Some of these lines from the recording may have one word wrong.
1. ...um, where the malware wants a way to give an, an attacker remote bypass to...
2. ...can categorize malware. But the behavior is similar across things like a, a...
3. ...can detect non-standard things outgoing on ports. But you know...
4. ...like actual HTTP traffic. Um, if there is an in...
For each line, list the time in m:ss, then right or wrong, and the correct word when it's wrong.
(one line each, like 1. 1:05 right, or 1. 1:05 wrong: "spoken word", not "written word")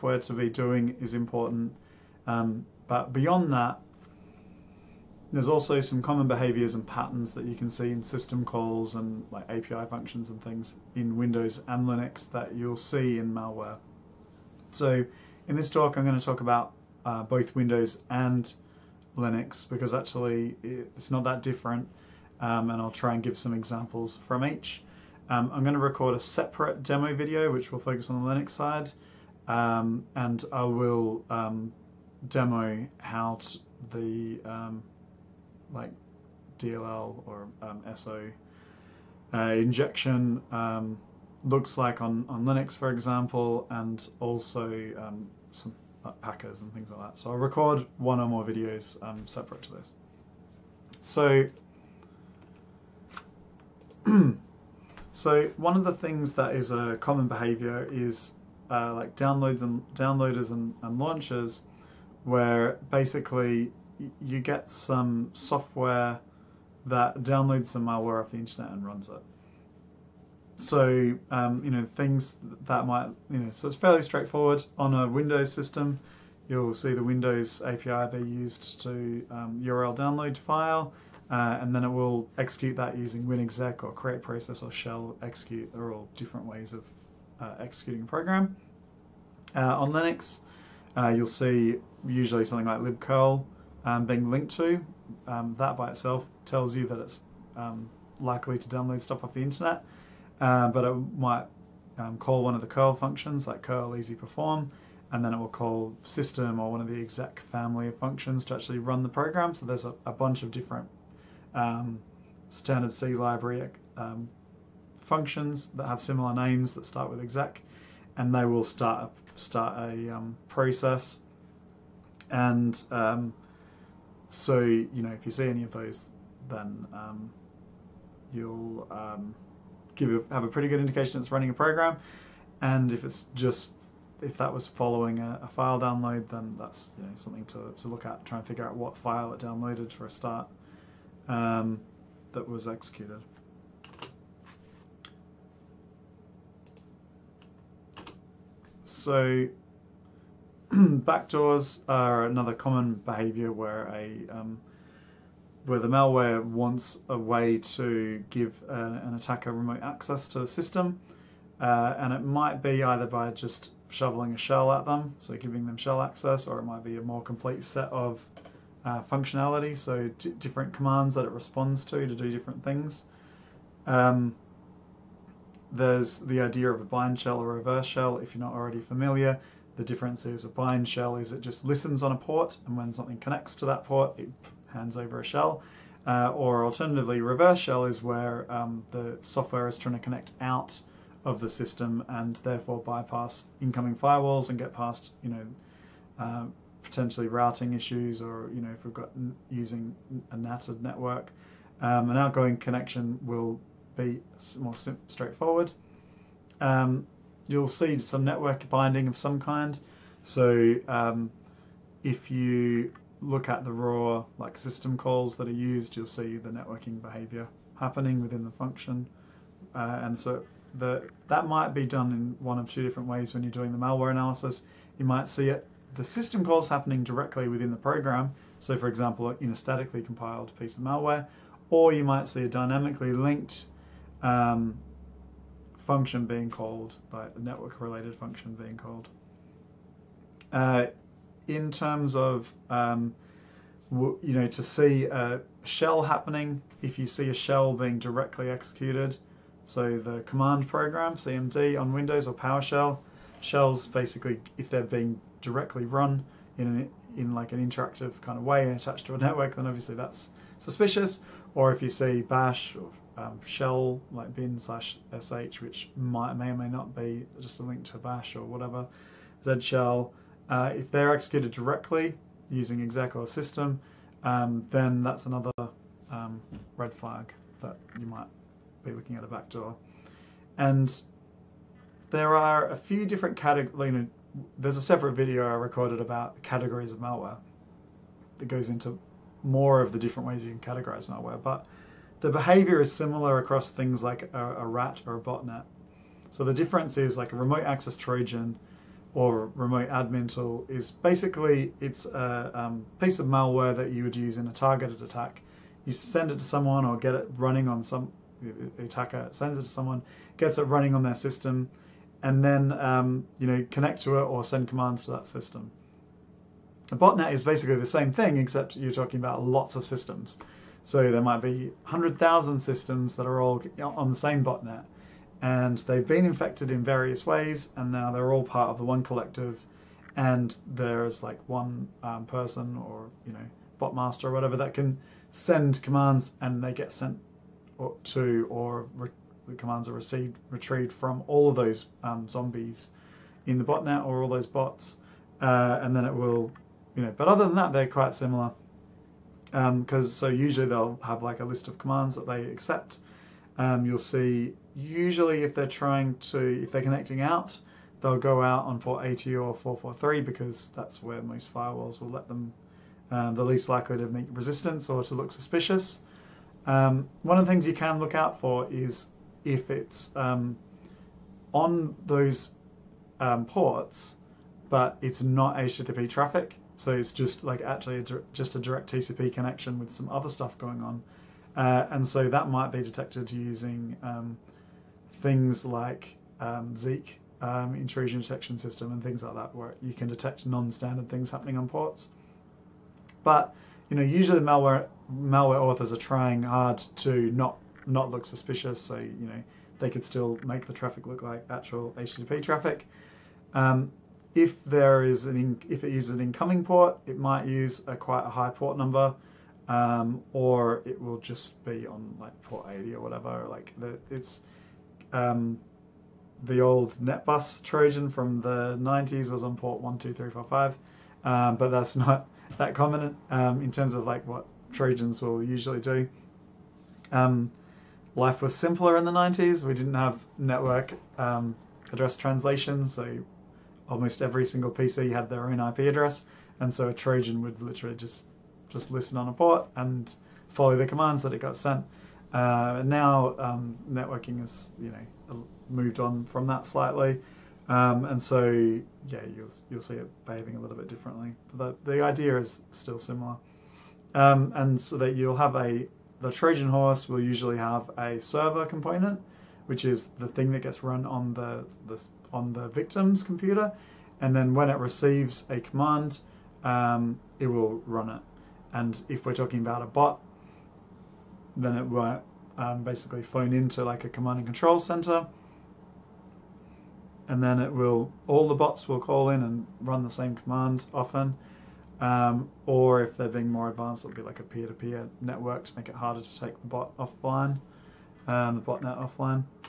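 1. 2:34 wrong: "access", not "bypass"
2. 4:50 right
3. 6:29 wrong: "happening", not "outgoing"
4. 6:41 right.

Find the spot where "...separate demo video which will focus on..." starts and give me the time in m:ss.
0:26.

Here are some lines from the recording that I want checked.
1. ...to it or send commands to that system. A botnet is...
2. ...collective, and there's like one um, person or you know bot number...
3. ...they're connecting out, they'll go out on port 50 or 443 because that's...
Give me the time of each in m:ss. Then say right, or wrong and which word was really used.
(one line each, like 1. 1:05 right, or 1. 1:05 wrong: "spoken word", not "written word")
1. 5:14 right
2. 5:29 wrong: "master", not "number"
3. 5:56 wrong: "80", not "50".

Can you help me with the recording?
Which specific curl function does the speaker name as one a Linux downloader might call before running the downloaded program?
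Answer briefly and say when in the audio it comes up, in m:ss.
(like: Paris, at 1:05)
curl easy perform, at 1:43.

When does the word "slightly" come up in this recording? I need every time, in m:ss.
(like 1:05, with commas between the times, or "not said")
7:26.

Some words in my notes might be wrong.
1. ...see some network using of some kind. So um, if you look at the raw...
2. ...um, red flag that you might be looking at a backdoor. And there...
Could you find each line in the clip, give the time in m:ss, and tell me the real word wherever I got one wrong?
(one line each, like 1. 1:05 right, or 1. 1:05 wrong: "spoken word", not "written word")
1. 3:27 wrong: "binding", not "using"
2. 4:36 right.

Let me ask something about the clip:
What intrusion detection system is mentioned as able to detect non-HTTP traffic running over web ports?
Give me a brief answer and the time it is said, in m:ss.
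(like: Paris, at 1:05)
Zeek, at 6:26.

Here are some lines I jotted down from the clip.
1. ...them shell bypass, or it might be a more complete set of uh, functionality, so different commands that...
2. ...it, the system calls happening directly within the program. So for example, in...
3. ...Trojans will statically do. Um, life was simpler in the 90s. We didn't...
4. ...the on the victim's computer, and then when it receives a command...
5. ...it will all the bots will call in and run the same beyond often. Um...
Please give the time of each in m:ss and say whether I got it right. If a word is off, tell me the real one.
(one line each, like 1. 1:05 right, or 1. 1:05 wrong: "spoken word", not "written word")
1. 2:45 wrong: "access", not "bypass"
2. 3:45 right
3. 7:04 wrong: "usually", not "statically"
4. 7:41 right
5. 7:57 wrong: "command", not "beyond".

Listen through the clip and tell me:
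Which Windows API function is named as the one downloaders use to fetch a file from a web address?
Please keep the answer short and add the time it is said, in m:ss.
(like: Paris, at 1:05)
URL download file, at 1:19.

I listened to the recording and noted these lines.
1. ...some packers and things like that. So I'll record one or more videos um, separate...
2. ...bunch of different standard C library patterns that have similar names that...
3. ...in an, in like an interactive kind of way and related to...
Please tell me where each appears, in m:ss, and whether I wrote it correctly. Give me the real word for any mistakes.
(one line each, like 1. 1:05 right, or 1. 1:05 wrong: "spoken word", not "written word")
1. 0:45 right
2. 1:50 wrong: "functions", not "patterns"
3. 4:16 wrong: "attached", not "related".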